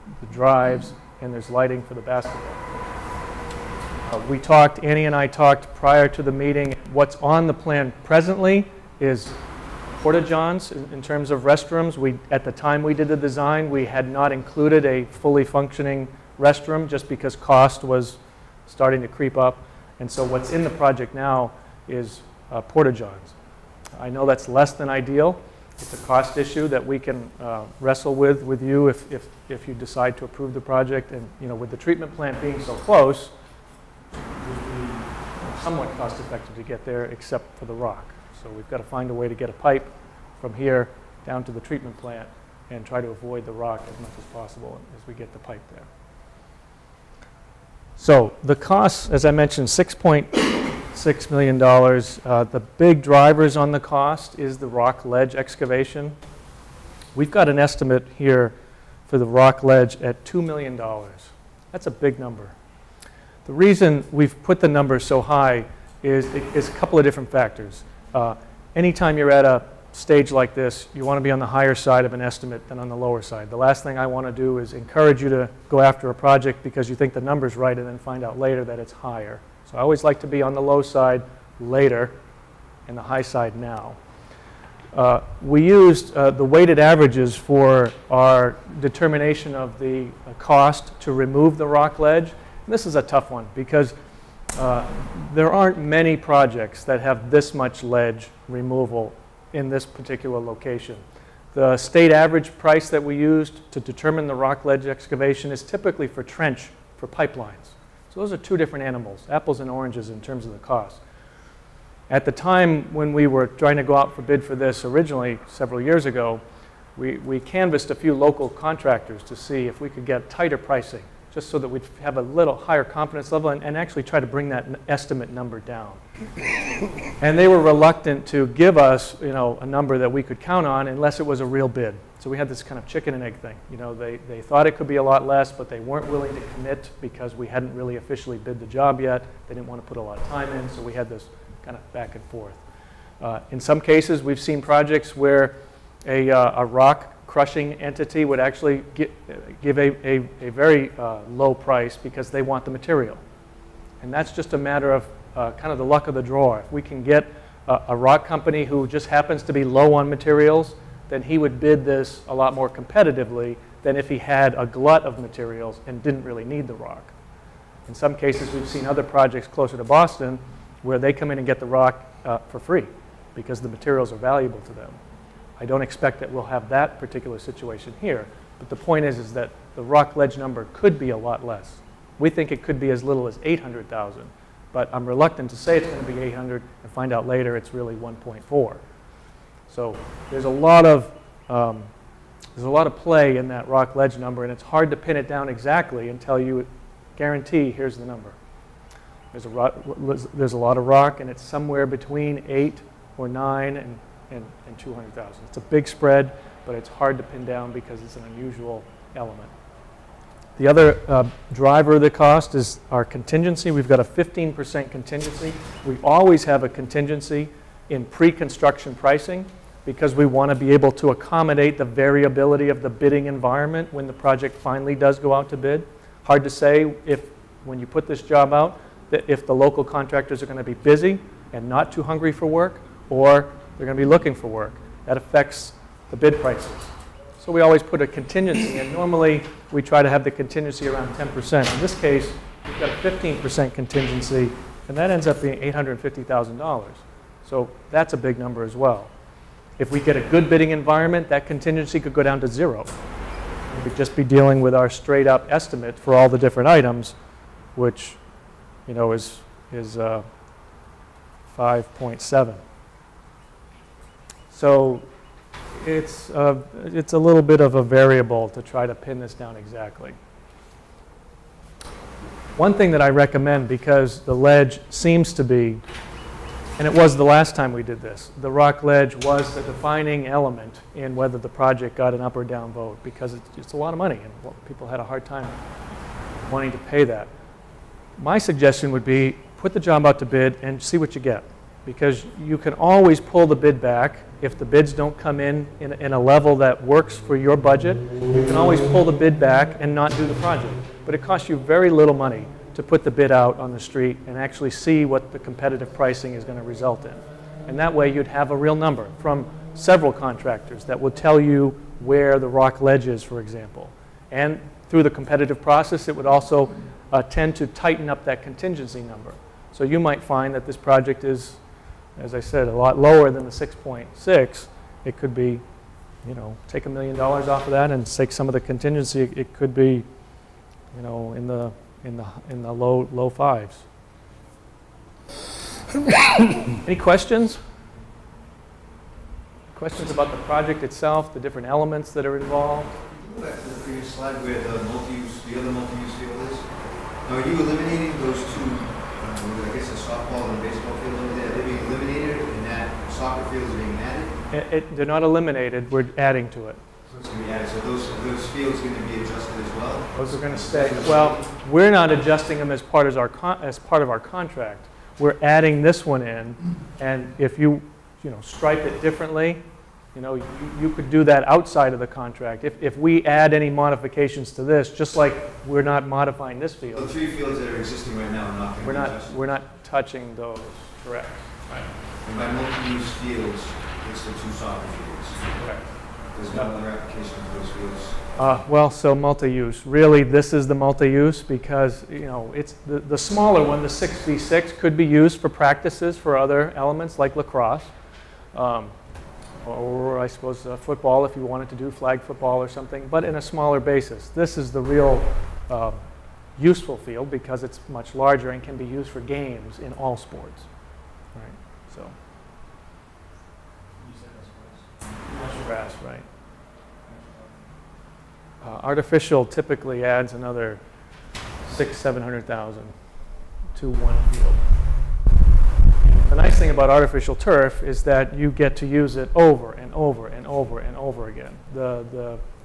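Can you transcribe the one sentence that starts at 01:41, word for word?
The state average price that we used to determine the rock ledge excavation is typically for trench for pipelines.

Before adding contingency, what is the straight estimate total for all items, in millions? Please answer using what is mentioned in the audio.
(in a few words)
5.7.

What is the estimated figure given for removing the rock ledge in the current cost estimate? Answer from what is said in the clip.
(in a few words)
$2 million.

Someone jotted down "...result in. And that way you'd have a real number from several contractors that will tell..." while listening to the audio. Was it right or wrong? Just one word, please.
right.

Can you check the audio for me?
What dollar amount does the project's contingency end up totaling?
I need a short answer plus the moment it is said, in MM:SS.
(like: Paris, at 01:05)
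$850,000, at 04:05.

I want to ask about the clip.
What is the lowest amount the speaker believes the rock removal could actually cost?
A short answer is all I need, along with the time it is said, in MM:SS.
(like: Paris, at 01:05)
800,000, at 03:03.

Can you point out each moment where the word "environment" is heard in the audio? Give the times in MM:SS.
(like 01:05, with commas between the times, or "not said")
03:43, 04:10.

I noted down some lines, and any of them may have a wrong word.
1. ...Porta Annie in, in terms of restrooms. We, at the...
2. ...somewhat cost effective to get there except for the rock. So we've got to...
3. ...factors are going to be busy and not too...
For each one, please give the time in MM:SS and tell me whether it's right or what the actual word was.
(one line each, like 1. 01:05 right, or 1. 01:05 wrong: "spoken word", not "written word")
1. 00:10 wrong: "Johns", not "Annie"
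2. 00:35 right
3. 03:49 wrong: "contractors", not "factors".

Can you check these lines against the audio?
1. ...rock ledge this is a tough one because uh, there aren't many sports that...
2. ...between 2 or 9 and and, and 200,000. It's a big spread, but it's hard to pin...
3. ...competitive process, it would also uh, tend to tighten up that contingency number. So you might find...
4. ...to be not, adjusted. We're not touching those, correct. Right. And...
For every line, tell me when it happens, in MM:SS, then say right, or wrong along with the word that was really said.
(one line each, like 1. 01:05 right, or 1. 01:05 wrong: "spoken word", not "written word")
1. 01:31 wrong: "projects", not "sports"
2. 03:21 wrong: "8", not "2"
3. 05:15 right
4. 06:18 right.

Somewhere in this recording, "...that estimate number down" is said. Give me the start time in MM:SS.
02:04.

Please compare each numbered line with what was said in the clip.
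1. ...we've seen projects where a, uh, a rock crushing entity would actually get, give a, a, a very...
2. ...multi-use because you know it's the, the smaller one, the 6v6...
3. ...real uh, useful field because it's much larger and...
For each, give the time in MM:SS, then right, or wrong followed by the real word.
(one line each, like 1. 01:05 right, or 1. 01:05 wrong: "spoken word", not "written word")
1. 02:24 right
2. 06:30 right
3. 06:44 right.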